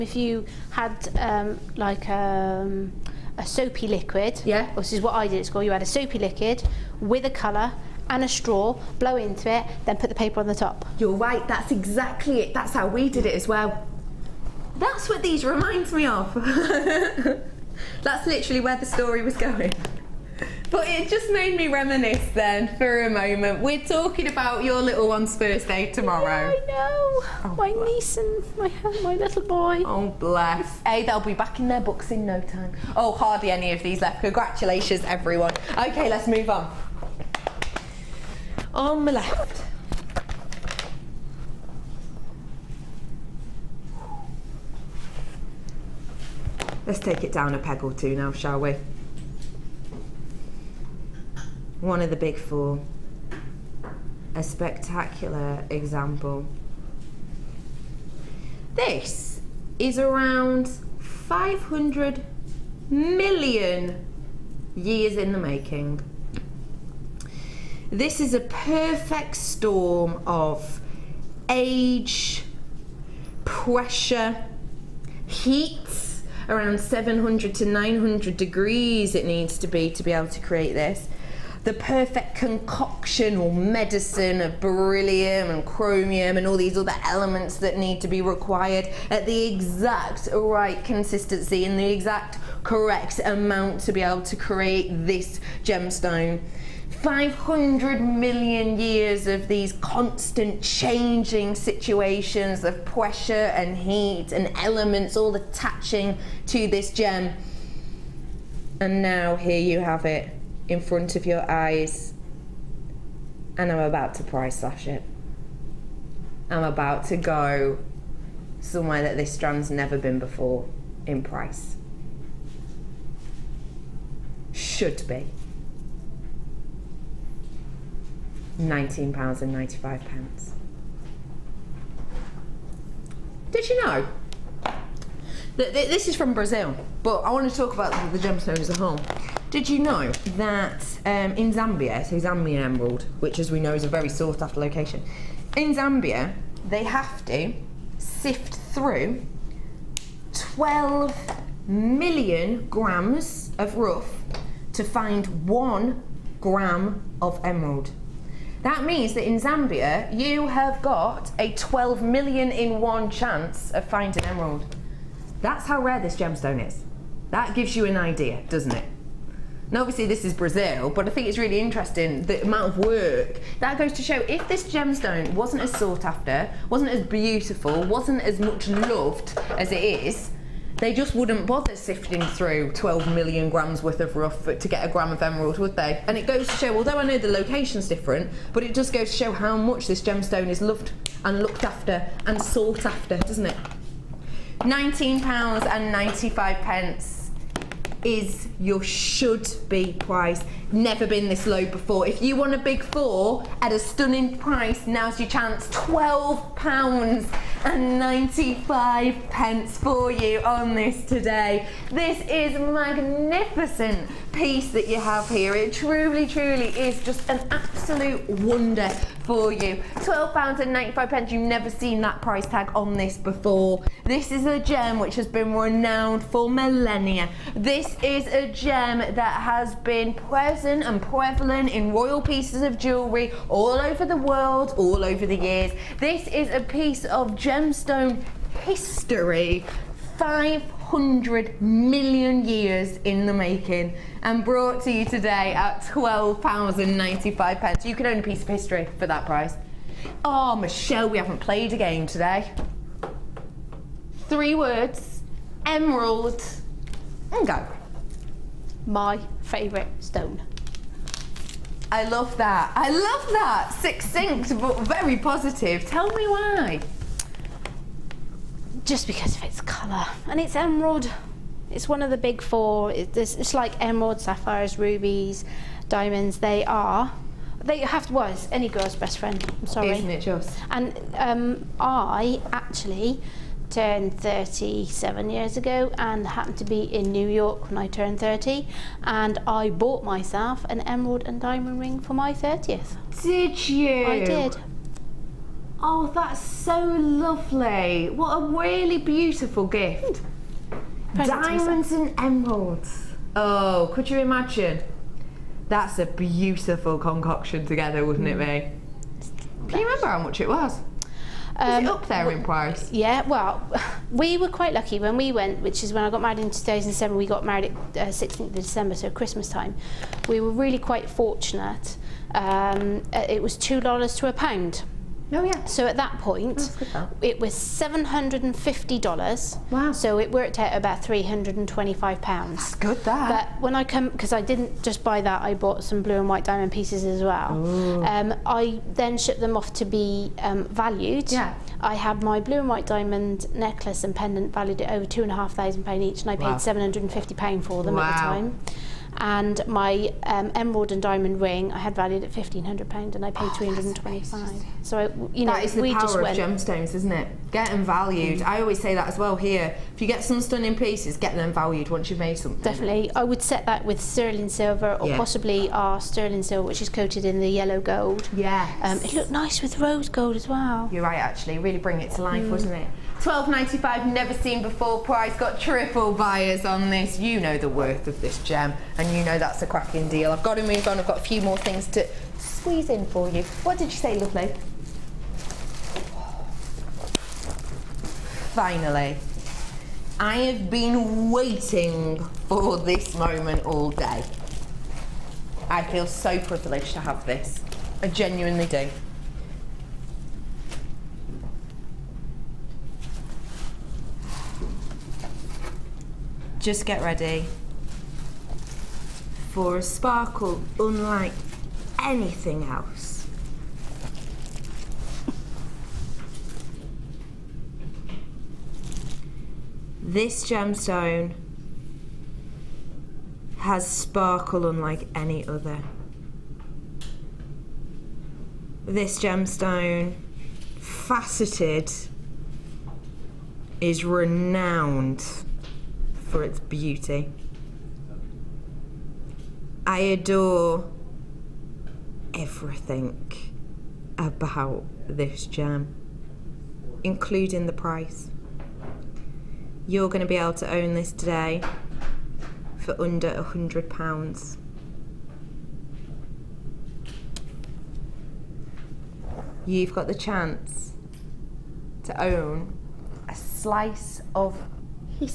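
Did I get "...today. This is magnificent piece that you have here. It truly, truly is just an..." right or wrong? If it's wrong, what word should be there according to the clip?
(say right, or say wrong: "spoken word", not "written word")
right.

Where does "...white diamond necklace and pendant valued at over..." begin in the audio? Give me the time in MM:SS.
05:42.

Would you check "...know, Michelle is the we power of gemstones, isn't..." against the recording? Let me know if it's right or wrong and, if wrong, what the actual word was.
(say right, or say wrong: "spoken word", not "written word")
wrong: "That", not "Michelle".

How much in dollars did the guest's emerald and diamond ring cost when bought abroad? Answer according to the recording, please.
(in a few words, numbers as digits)
$750.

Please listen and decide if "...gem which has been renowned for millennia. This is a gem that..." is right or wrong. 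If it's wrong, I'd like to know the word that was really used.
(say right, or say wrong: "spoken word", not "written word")
right.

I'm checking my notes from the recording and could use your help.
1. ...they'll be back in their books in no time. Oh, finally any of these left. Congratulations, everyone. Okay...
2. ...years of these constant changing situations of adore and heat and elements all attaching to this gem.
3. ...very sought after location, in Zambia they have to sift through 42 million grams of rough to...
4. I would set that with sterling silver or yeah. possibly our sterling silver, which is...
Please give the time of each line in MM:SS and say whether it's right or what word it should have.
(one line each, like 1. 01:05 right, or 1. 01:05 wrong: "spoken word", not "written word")
1. 00:31 wrong: "hardly", not "finally"
2. 01:38 wrong: "pressure", not "adore"
3. 02:23 wrong: "12", not "42"
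4. 06:03 right.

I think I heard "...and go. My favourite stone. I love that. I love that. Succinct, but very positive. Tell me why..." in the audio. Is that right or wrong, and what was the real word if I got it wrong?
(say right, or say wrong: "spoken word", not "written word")
right.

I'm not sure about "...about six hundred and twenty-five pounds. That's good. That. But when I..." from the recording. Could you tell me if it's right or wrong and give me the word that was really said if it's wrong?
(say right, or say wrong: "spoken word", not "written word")
wrong: "three", not "six".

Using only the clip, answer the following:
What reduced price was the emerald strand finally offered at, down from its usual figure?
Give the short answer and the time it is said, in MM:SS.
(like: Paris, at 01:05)
£12.95, at 03:25.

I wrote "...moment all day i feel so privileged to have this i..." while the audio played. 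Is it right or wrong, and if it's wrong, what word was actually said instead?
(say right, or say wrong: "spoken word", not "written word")
right.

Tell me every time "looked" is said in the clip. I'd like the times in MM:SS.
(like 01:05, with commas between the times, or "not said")
03:11, 06:09.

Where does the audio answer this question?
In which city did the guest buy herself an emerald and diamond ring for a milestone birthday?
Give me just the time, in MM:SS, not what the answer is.
04:47.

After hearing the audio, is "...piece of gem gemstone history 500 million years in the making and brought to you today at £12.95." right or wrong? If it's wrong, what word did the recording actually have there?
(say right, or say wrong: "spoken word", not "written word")
right.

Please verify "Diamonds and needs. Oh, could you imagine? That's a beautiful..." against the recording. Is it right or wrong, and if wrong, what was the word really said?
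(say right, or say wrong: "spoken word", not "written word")
wrong: "emeralds", not "needs".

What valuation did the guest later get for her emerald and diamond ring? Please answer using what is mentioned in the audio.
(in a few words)
£1,500.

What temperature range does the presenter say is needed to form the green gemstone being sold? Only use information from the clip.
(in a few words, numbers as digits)
700 to 900 degrees.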